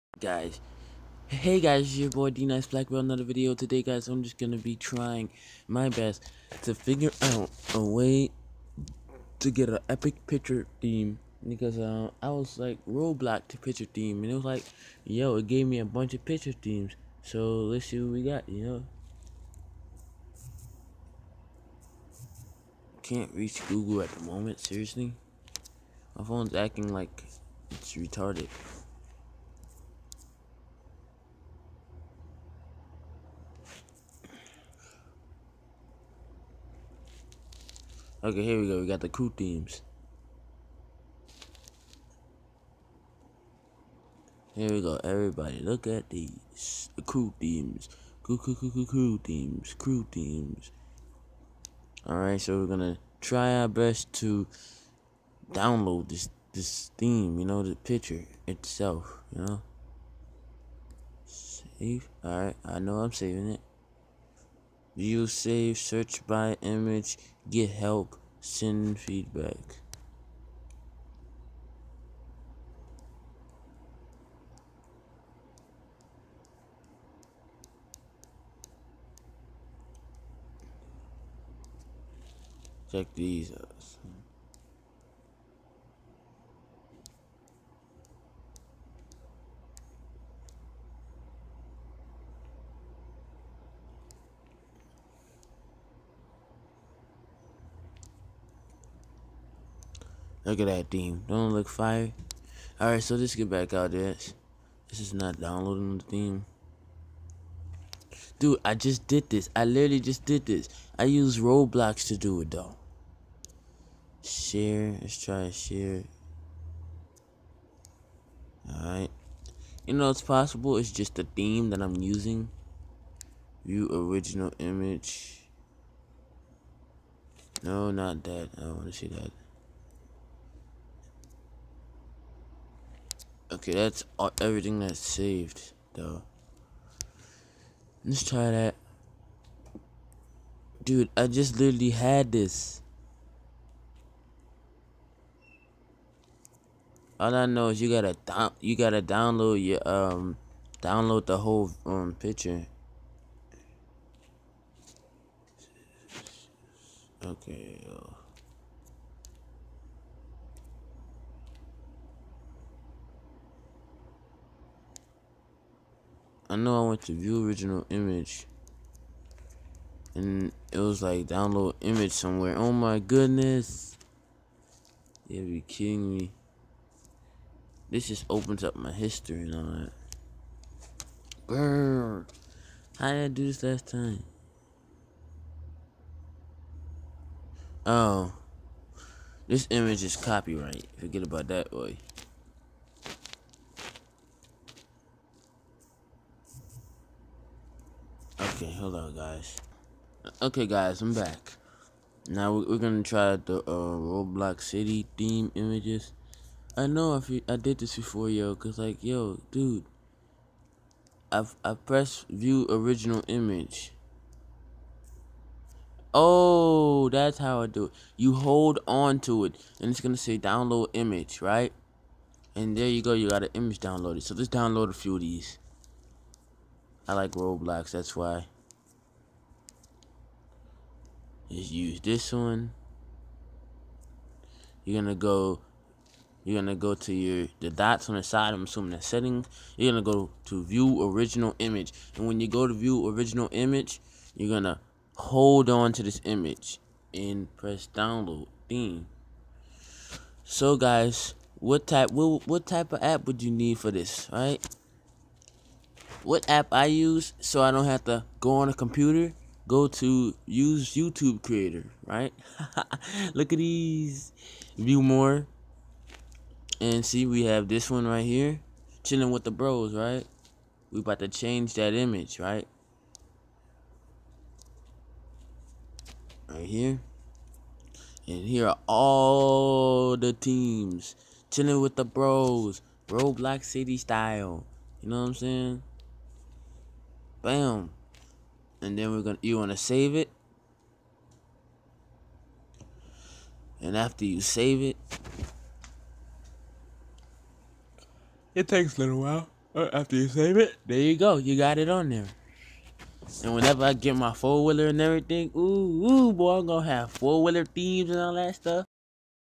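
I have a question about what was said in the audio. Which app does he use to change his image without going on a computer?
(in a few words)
YouTube creator.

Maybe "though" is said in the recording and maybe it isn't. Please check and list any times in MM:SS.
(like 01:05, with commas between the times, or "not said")
01:52, 02:15.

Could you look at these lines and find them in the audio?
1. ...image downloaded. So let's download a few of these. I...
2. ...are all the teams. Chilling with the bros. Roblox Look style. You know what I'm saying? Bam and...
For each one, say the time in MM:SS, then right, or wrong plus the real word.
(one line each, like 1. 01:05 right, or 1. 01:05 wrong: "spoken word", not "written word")
1. 03:43 right
2. 04:38 wrong: "City", not "Look".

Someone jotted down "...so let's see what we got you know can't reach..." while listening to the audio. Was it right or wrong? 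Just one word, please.
right.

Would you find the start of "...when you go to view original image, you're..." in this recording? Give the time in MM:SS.
04:02.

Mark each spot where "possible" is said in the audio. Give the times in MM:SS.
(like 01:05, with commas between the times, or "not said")
02:00.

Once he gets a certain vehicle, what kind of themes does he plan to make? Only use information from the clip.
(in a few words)
four wheeler themes.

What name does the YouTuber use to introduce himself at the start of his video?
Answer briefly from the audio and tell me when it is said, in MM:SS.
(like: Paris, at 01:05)
D Nice Black, at 00:02.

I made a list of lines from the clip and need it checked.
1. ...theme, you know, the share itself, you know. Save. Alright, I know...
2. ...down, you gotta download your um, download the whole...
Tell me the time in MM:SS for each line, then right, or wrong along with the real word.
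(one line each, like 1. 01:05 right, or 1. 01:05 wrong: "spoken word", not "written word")
1. 00:56 wrong: "picture", not "share"
2. 02:28 right.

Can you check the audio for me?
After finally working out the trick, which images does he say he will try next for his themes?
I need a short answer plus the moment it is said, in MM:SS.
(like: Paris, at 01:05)
Roblox City theme images, at 03:23.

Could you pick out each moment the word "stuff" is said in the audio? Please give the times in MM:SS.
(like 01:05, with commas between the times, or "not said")
05:08.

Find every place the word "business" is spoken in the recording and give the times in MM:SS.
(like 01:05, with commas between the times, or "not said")
not said.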